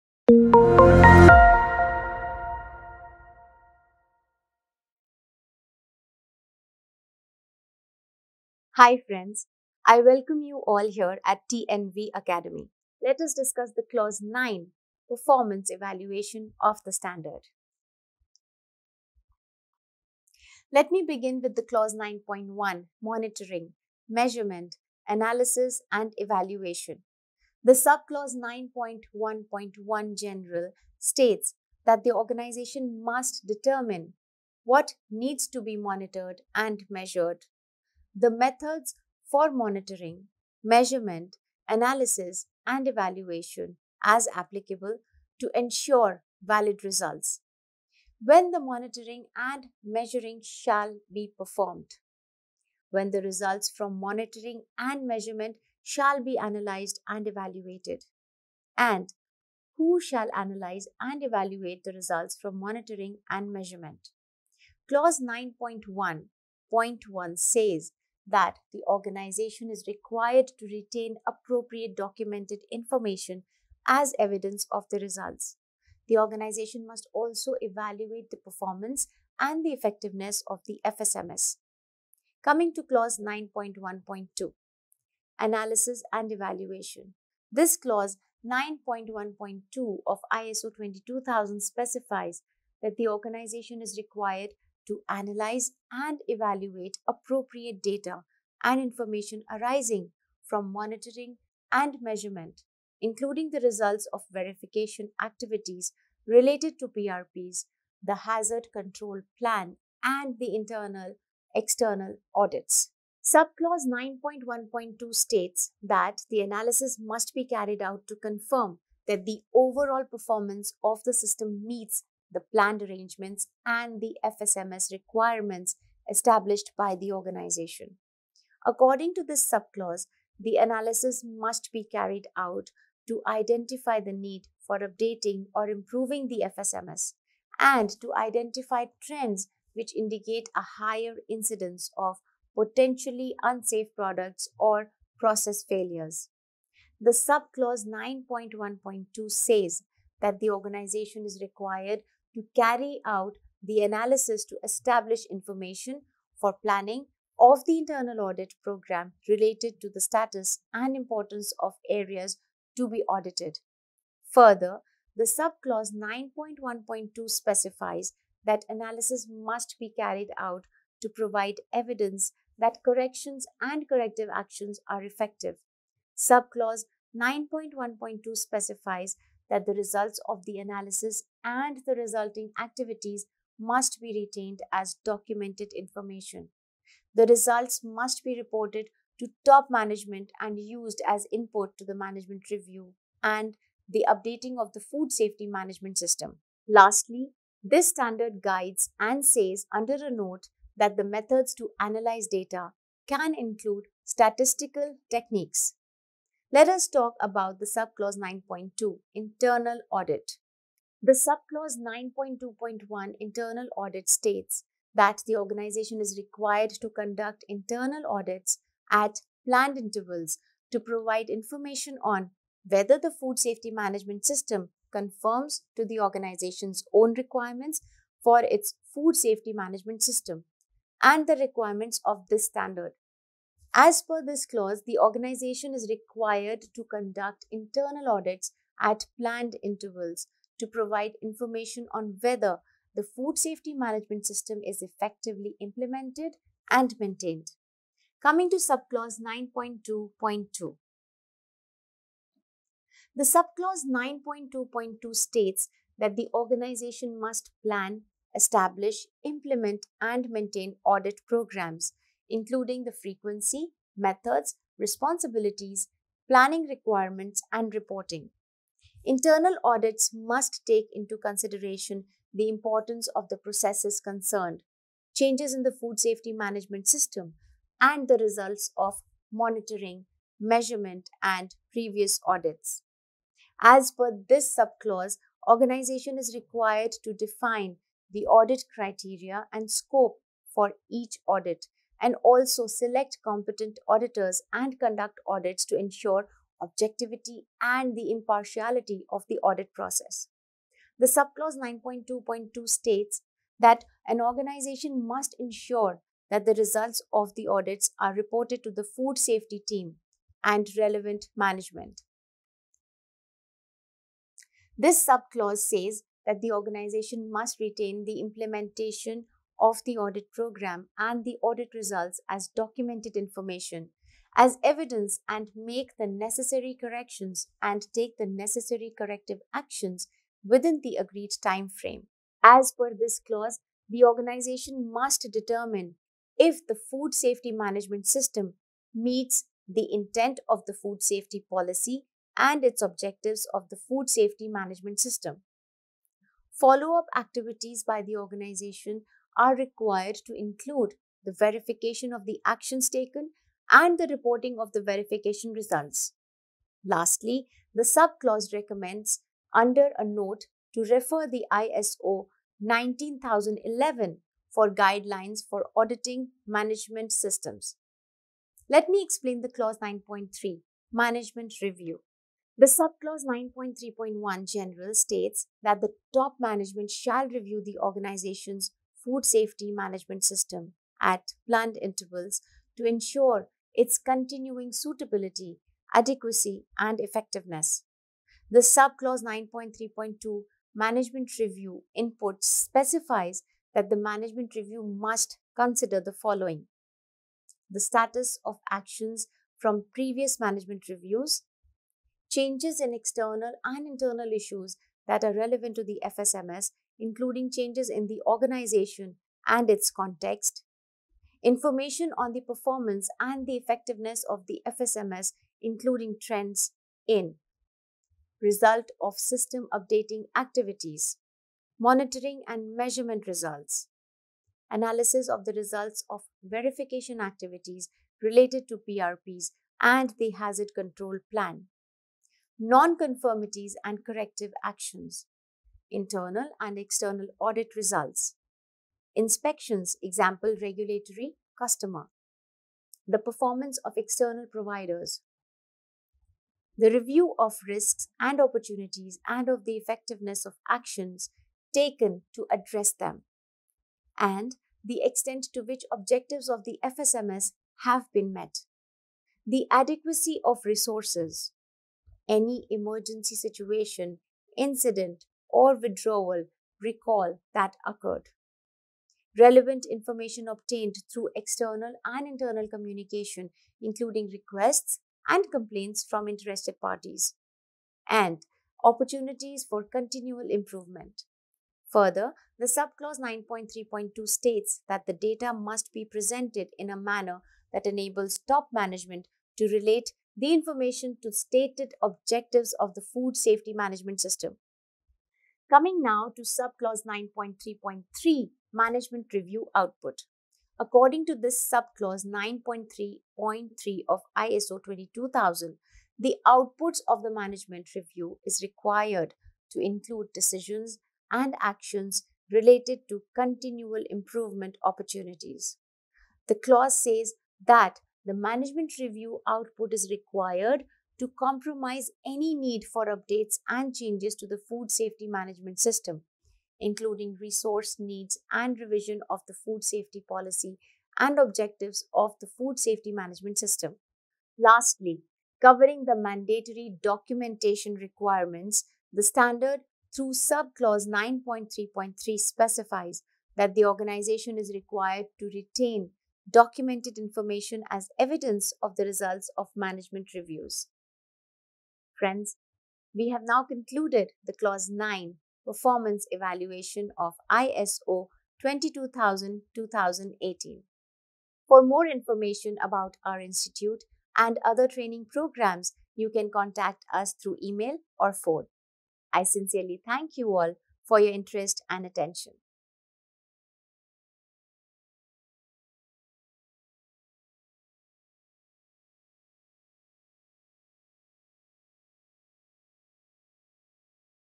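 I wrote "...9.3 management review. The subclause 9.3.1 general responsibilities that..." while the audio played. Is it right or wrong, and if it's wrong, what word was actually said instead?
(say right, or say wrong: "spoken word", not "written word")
wrong: "states", not "responsibilities".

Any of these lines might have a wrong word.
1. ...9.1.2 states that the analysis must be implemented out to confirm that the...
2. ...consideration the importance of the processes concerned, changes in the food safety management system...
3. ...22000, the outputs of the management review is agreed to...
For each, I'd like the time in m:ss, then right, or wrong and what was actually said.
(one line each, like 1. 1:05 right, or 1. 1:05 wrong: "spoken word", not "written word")
1. 1:53 wrong: "carried", not "implemented"
2. 4:31 right
3. 8:24 wrong: "required", not "agreed".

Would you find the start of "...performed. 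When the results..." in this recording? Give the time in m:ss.
0:51.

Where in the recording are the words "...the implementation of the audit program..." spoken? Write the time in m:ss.
5:18.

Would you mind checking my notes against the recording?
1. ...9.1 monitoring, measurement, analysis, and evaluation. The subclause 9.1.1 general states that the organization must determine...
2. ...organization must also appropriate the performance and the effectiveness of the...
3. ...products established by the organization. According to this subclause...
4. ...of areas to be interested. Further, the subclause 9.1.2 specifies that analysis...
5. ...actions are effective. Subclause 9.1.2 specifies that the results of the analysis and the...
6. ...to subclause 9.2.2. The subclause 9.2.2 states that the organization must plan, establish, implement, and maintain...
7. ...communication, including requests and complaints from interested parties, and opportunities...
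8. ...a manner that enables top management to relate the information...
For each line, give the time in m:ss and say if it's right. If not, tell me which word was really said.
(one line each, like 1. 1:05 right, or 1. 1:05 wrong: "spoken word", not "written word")
1. 0:21 right
2. 1:16 wrong: "evaluate", not "appropriate"
3. 2:04 wrong: "requirements", not "products"
4. 2:41 wrong: "audited", not "interested"
5. 2:54 right
6. 4:08 right
7. 7:52 right
8. 8:06 right.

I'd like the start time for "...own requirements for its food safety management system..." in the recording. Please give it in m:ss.
3:46.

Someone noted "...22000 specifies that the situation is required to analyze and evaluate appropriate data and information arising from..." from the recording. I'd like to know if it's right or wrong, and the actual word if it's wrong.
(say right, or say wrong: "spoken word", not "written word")
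wrong: "organization", not "situation".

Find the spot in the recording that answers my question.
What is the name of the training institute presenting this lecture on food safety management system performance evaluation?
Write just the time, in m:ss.
0:11.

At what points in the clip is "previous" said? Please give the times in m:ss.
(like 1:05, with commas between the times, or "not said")
4:41, 6:39.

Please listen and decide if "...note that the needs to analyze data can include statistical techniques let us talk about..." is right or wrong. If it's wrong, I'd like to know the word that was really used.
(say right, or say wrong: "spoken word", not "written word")
wrong: "methods", not "needs".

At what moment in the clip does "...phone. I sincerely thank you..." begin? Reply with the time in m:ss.
9:28.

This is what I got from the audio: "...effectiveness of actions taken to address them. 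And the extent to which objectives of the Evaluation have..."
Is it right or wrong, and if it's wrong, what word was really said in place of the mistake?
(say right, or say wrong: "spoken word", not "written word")
wrong: "FSMS", not "Evaluation".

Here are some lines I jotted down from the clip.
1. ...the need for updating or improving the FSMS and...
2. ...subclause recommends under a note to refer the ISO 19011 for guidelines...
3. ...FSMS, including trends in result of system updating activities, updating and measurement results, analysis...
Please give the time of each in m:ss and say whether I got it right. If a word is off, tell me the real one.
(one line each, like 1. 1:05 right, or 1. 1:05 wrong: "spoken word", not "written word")
1. 2:13 right
2. 5:57 right
3. 6:54 wrong: "monitoring", not "updating".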